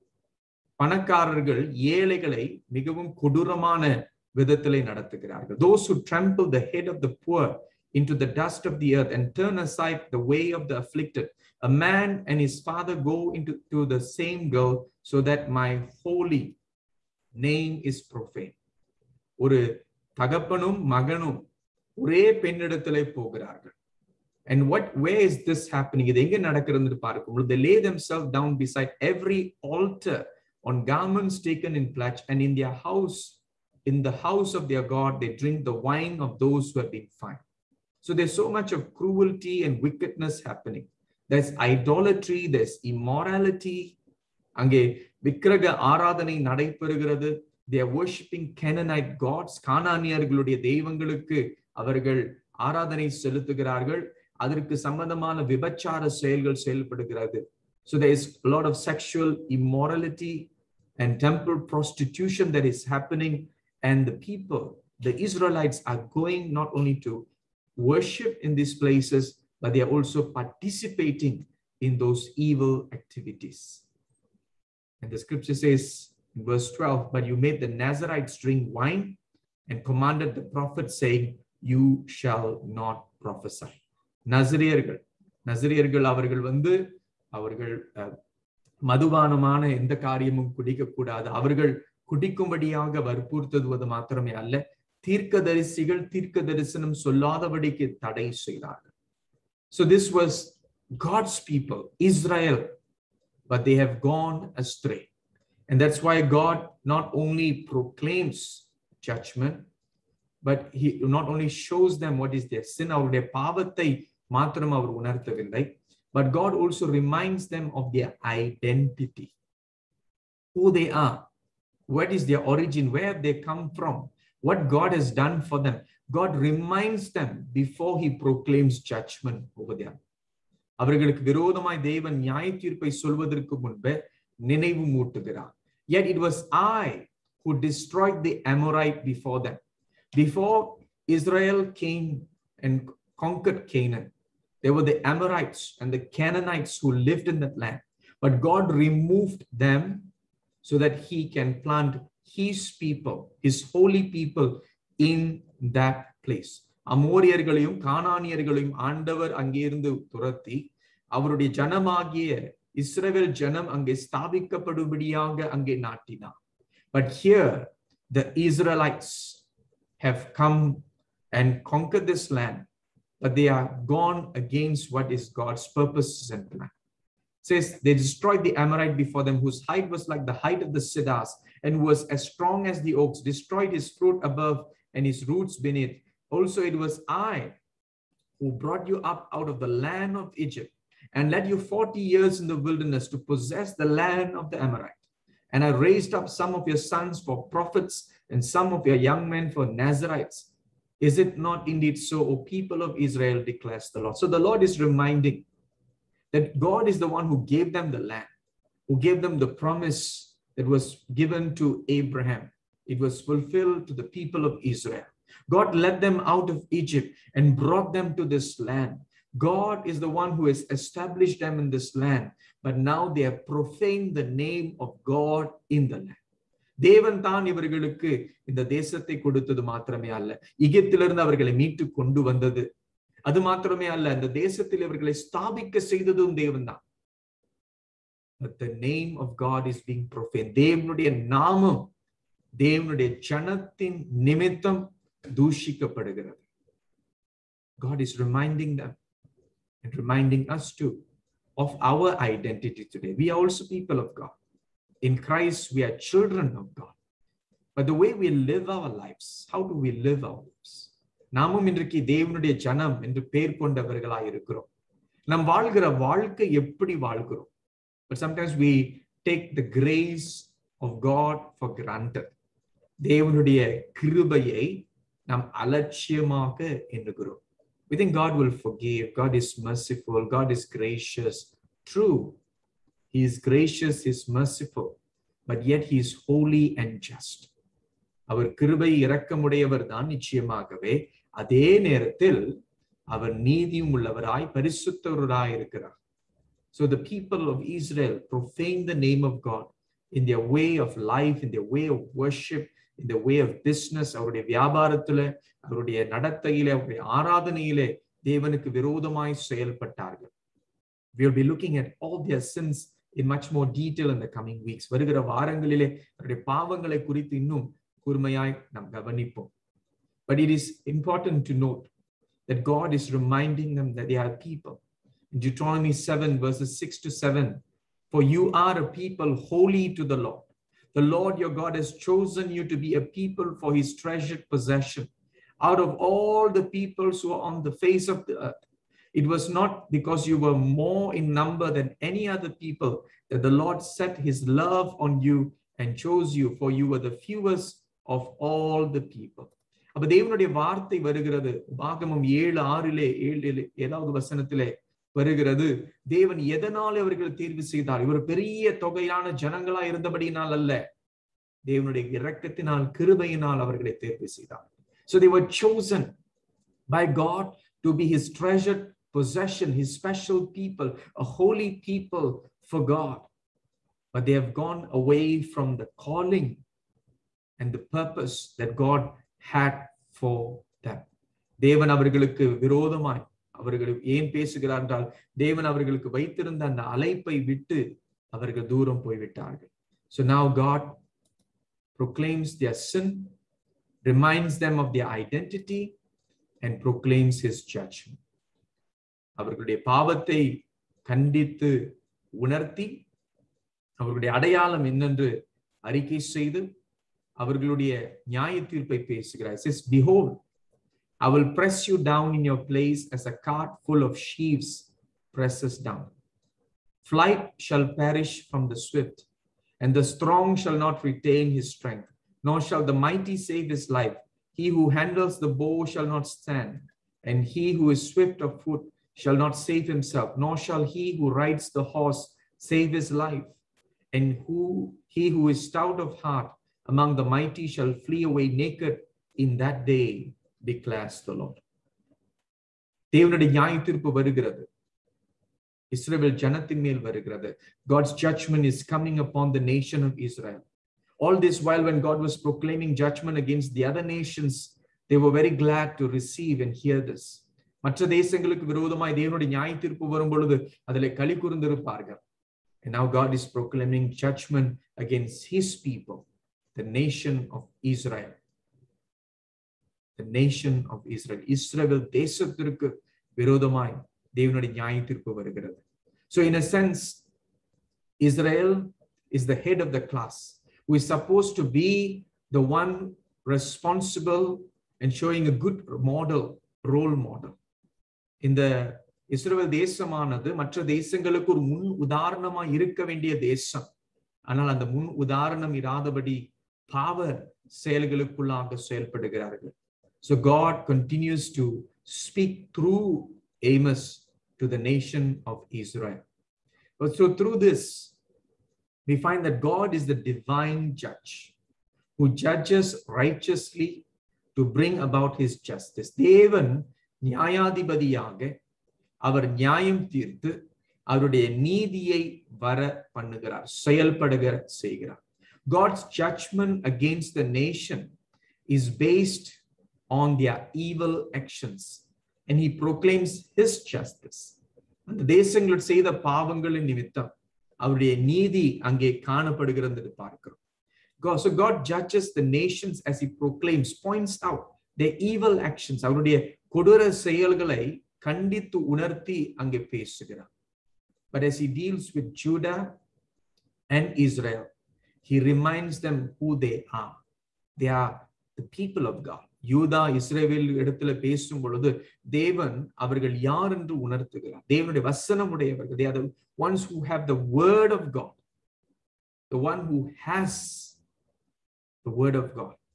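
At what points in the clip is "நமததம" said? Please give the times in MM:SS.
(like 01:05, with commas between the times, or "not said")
04:04, 08:56.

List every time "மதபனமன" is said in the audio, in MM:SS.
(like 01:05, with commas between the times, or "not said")
01:28.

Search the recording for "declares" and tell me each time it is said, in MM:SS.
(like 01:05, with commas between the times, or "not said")
03:23, 07:20.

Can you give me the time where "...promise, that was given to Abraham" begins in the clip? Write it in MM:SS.
03:29.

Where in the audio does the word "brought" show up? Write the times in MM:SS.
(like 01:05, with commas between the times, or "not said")
03:08, 03:37.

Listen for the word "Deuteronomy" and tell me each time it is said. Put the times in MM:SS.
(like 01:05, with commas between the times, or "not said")
05:25.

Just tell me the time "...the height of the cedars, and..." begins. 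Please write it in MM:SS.
03:00.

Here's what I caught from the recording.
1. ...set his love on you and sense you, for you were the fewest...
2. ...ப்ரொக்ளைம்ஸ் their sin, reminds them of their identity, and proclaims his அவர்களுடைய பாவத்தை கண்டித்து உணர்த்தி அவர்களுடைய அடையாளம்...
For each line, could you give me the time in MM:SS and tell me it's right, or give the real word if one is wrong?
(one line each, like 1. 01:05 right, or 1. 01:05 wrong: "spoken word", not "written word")
1. 05:43 wrong: "chose", not "sense"
2. 06:31 right.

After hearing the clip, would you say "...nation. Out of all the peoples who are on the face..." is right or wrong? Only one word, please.
wrong.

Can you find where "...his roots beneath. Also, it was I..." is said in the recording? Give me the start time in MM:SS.
03:05.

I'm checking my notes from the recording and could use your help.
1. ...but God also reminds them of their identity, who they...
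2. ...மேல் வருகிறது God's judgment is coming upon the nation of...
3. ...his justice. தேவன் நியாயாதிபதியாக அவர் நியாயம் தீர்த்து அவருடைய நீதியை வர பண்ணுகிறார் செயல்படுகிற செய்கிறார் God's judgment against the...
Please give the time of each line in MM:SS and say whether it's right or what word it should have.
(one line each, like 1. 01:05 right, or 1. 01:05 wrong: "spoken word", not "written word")
1. 01:56 right
2. 07:26 right
3. 08:35 right.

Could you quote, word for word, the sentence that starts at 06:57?
Flight shall perish from the swift, and the strong shall not retain his strength, nor shall the mighty save his life.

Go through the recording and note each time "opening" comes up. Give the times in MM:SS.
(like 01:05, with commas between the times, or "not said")
not said.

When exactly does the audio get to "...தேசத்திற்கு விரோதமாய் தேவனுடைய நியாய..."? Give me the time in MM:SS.
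07:52.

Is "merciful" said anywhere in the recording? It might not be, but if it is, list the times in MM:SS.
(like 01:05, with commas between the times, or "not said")
04:39, 04:44.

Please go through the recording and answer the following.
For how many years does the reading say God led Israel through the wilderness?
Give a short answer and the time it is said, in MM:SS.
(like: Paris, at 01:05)
40, at 03:11.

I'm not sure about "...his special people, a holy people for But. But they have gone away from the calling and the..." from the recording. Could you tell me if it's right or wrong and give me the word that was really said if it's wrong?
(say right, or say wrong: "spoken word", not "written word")
wrong: "God", not "But".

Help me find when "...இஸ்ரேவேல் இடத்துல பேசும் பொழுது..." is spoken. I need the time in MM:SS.
09:20.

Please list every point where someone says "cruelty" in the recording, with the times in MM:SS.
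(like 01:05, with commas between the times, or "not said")
00:38.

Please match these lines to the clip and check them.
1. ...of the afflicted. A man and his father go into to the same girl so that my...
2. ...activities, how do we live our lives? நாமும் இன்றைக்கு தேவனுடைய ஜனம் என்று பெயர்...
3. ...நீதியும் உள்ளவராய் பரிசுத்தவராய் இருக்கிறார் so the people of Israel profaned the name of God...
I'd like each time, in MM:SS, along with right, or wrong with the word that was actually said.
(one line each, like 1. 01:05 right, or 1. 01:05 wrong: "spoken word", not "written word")
1. 00:10 right
2. 04:19 wrong: "lives", not "activities"
3. 04:53 right.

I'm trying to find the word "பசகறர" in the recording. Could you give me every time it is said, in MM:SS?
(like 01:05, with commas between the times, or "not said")
06:24, 06:49, 09:09.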